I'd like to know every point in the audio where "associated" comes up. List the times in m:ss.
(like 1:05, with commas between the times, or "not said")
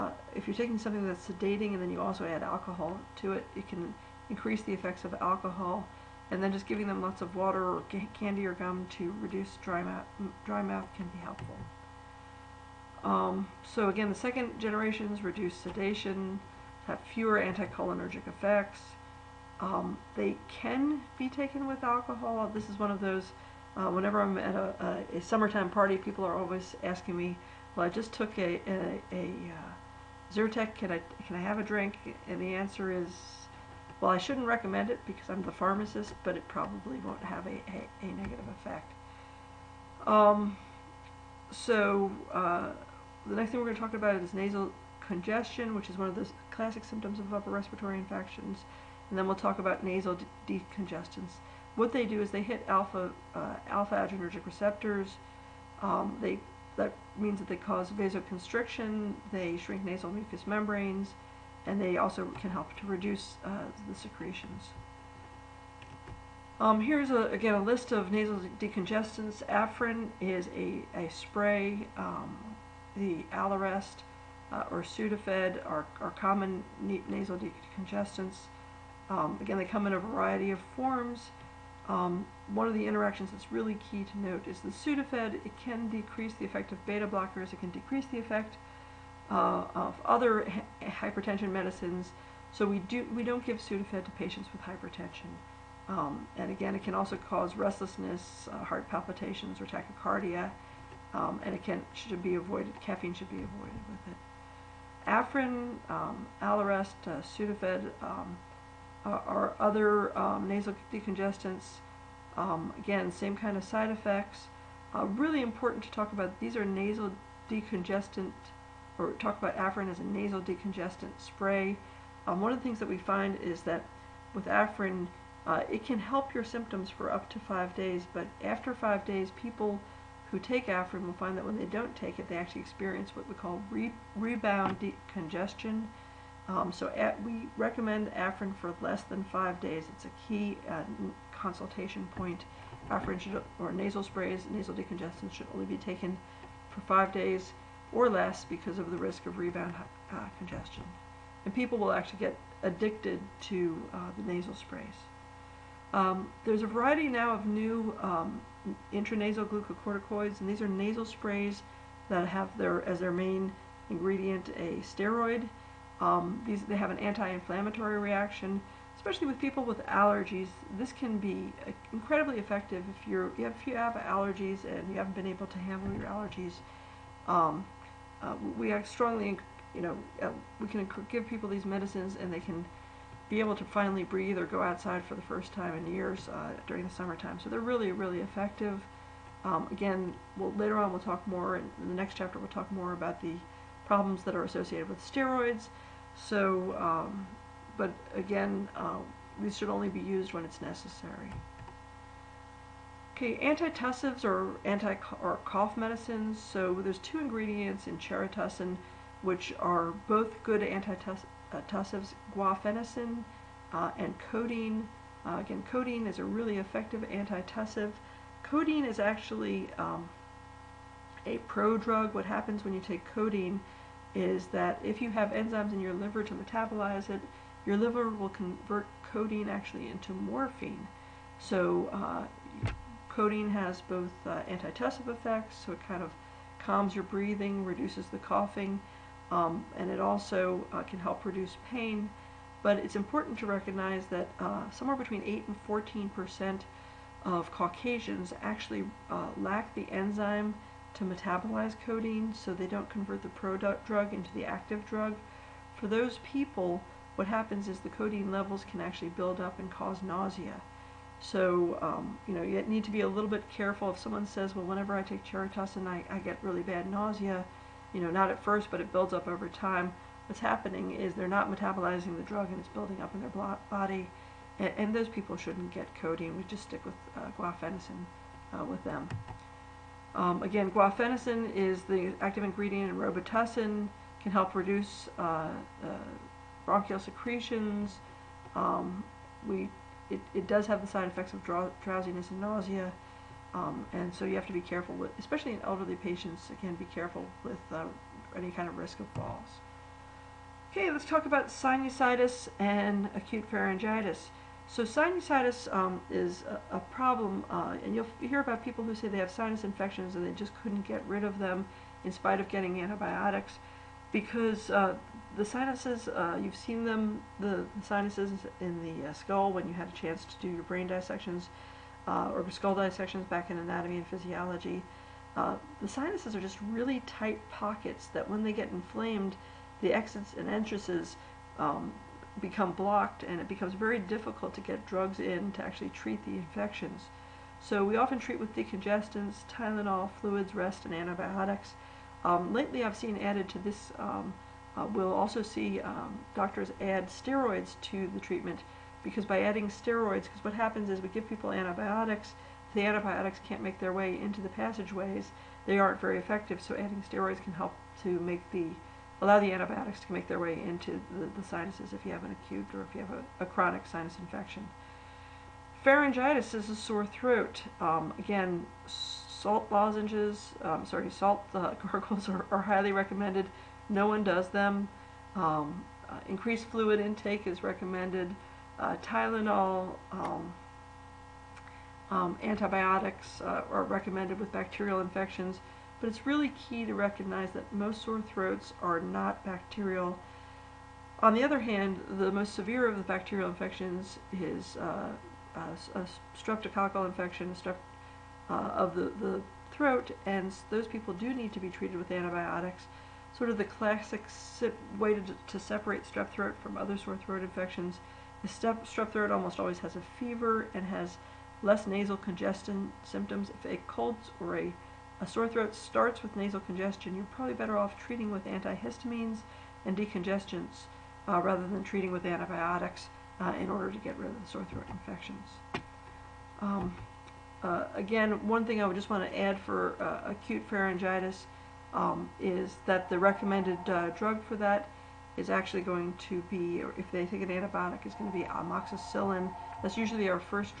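3:14.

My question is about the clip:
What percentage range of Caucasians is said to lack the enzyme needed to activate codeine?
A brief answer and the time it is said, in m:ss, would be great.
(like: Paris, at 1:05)
8 to 14 percent, at 4:05.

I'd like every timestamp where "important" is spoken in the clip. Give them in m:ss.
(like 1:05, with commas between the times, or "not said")
1:55, 4:02.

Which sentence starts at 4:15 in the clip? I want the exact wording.
For those people, what happens is the codeine levels can actually build up and cause nausea.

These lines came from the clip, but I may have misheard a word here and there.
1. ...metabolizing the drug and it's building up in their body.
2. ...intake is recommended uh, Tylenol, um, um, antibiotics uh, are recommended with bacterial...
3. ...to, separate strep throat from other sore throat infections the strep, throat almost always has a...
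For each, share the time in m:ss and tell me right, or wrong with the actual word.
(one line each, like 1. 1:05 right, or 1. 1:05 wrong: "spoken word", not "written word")
1. 4:31 right
2. 6:16 right
3. 6:45 right.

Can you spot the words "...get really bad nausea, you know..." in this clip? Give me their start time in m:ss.
4:26.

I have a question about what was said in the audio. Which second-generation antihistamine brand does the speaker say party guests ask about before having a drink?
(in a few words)
Zyrtec.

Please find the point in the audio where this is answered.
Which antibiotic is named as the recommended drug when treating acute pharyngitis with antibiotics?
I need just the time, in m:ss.
7:18.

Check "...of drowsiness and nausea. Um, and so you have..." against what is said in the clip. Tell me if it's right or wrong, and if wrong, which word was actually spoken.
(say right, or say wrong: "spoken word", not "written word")
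right.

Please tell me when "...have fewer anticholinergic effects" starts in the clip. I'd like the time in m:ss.
0:16.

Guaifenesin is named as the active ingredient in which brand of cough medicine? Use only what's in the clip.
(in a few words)
Robitussin.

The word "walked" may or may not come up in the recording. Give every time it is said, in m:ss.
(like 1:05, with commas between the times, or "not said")
not said.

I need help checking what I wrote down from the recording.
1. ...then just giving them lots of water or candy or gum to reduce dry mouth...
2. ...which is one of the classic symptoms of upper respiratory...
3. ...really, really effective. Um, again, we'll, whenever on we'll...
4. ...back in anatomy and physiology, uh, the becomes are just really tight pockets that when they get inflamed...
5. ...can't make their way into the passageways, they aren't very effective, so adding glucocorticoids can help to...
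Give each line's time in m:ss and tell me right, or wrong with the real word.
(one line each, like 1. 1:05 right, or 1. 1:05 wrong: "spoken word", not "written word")
1. 0:06 right
2. 0:45 right
3. 3:07 wrong: "later", not "whenever"
4. 5:23 wrong: "sinuses", not "becomes"
5. 5:53 wrong: "steroids", not "glucocorticoids".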